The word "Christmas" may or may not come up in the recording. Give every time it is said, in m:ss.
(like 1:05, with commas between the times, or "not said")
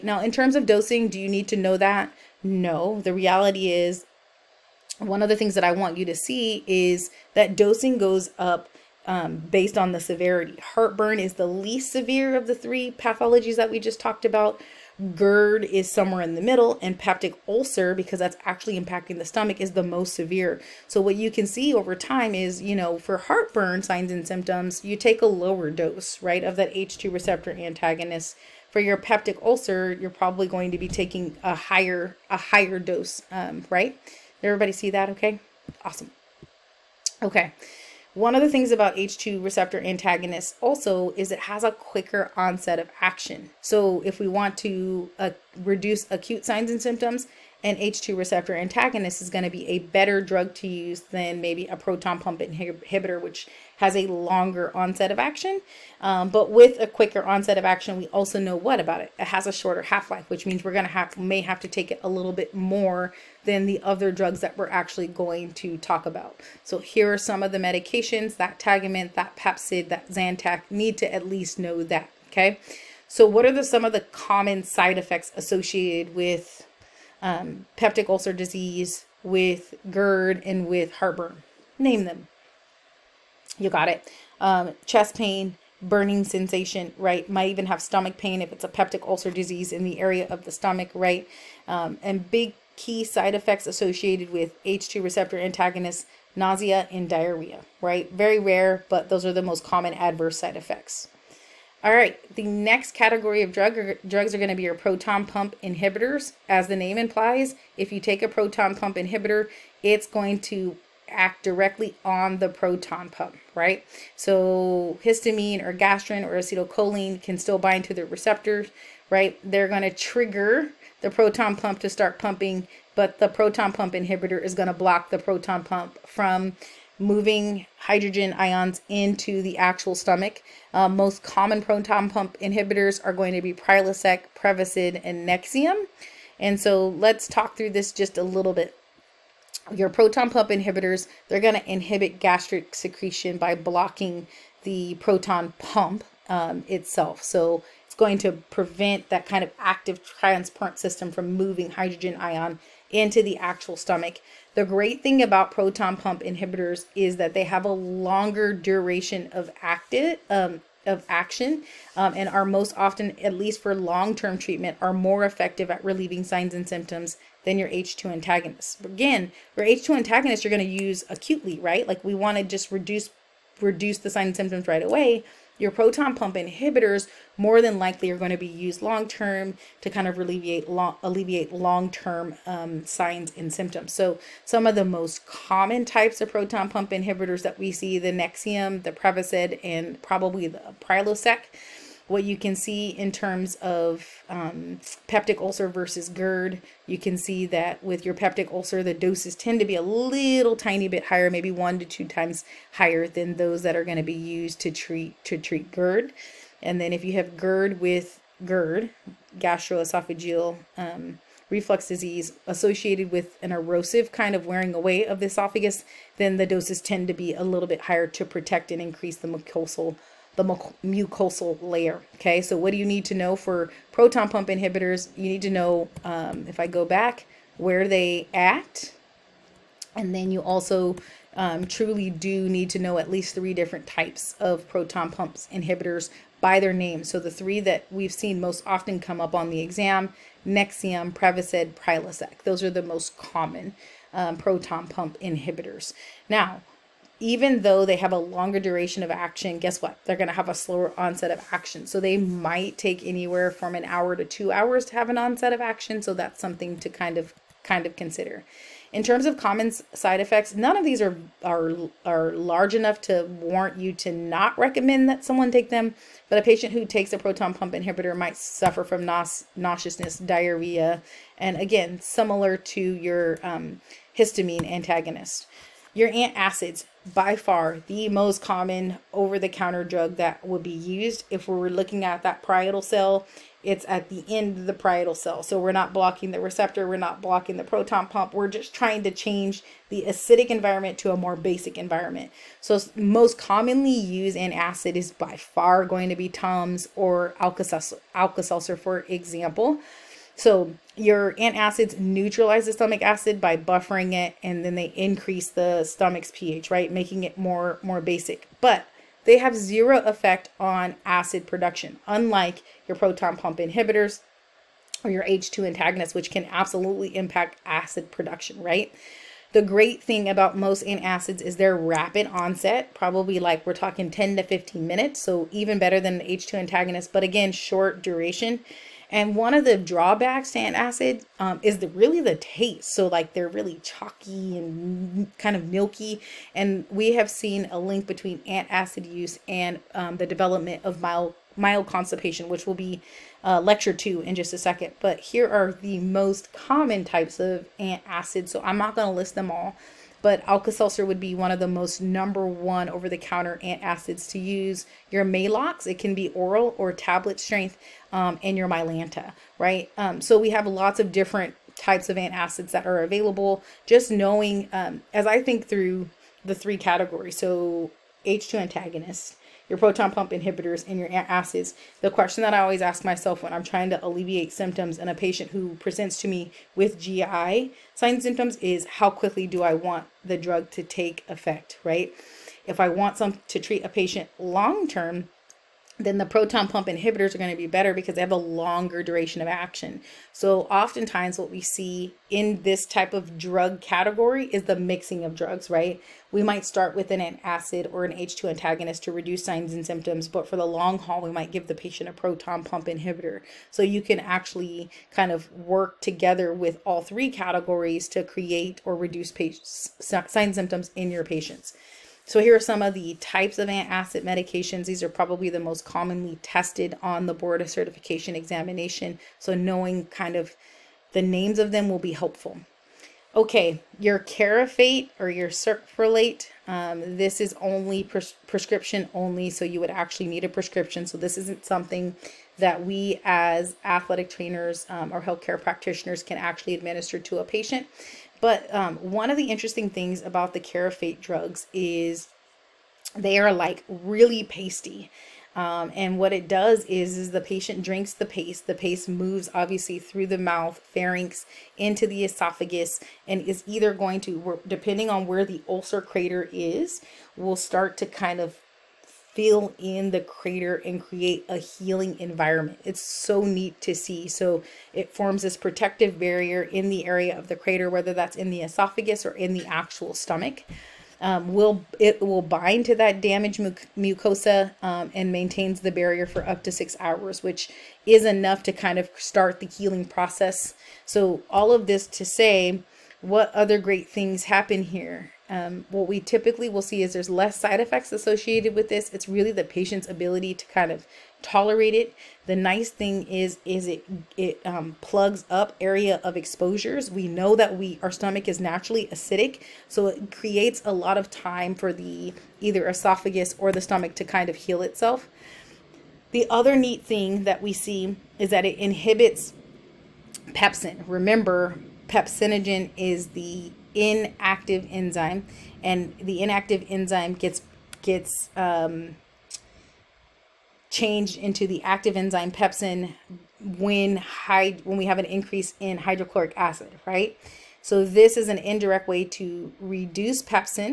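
not said.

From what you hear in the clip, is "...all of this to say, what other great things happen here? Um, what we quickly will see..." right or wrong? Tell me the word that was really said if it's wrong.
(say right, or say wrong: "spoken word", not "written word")
wrong: "typically", not "quickly".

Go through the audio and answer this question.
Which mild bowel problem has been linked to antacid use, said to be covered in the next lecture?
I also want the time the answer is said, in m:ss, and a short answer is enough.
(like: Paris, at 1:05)
Constipation, at 5:41.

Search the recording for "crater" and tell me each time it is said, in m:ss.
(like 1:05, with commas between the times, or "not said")
7:35, 7:40, 7:47.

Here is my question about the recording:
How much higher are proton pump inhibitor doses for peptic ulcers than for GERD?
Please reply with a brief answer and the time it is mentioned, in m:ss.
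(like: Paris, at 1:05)
1 to 2 times, at 3:21.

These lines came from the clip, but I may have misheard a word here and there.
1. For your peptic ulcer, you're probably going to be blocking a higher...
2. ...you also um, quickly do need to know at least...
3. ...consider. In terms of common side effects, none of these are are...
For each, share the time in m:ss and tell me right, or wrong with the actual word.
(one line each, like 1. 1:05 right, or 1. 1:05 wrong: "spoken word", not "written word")
1. 0:28 wrong: "taking", not "blocking"
2. 3:50 wrong: "truly", not "quickly"
3. 4:17 right.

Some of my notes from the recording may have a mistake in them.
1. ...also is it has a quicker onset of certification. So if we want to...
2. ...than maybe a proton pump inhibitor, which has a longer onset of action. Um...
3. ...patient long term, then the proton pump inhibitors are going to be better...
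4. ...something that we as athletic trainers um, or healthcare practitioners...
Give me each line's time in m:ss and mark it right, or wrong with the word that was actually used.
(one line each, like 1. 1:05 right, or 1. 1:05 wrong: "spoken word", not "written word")
1. 0:40 wrong: "action", not "certification"
2. 0:50 right
3. 6:23 right
4. 7:11 right.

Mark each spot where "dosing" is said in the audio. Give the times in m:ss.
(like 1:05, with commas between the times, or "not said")
0:00, 0:07.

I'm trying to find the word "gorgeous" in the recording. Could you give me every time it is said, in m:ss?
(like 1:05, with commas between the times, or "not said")
not said.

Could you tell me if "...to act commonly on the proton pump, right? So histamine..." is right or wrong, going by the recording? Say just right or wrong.
wrong.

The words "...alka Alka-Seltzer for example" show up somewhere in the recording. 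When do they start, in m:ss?
4:57.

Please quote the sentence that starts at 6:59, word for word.
So knowing kind of the names of them will be helpful.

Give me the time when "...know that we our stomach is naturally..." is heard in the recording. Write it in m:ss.
8:17.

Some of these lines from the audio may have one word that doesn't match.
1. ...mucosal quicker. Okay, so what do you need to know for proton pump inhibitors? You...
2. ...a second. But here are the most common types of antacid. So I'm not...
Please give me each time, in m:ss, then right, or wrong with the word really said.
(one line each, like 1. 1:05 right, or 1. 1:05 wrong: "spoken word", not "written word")
1. 3:40 wrong: "layer", not "quicker"
2. 5:44 right.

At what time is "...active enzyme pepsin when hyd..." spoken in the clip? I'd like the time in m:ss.
8:41.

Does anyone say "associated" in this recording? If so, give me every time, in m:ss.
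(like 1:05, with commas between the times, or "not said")
1:15, 1:33, 3:32, 8:08.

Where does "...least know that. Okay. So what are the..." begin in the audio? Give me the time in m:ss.
1:11.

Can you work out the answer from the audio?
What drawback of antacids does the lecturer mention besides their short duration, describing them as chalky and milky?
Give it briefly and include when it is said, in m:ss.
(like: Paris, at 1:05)
The taste, at 5:32.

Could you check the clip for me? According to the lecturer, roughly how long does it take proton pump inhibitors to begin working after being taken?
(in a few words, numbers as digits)
1 to 2 hours.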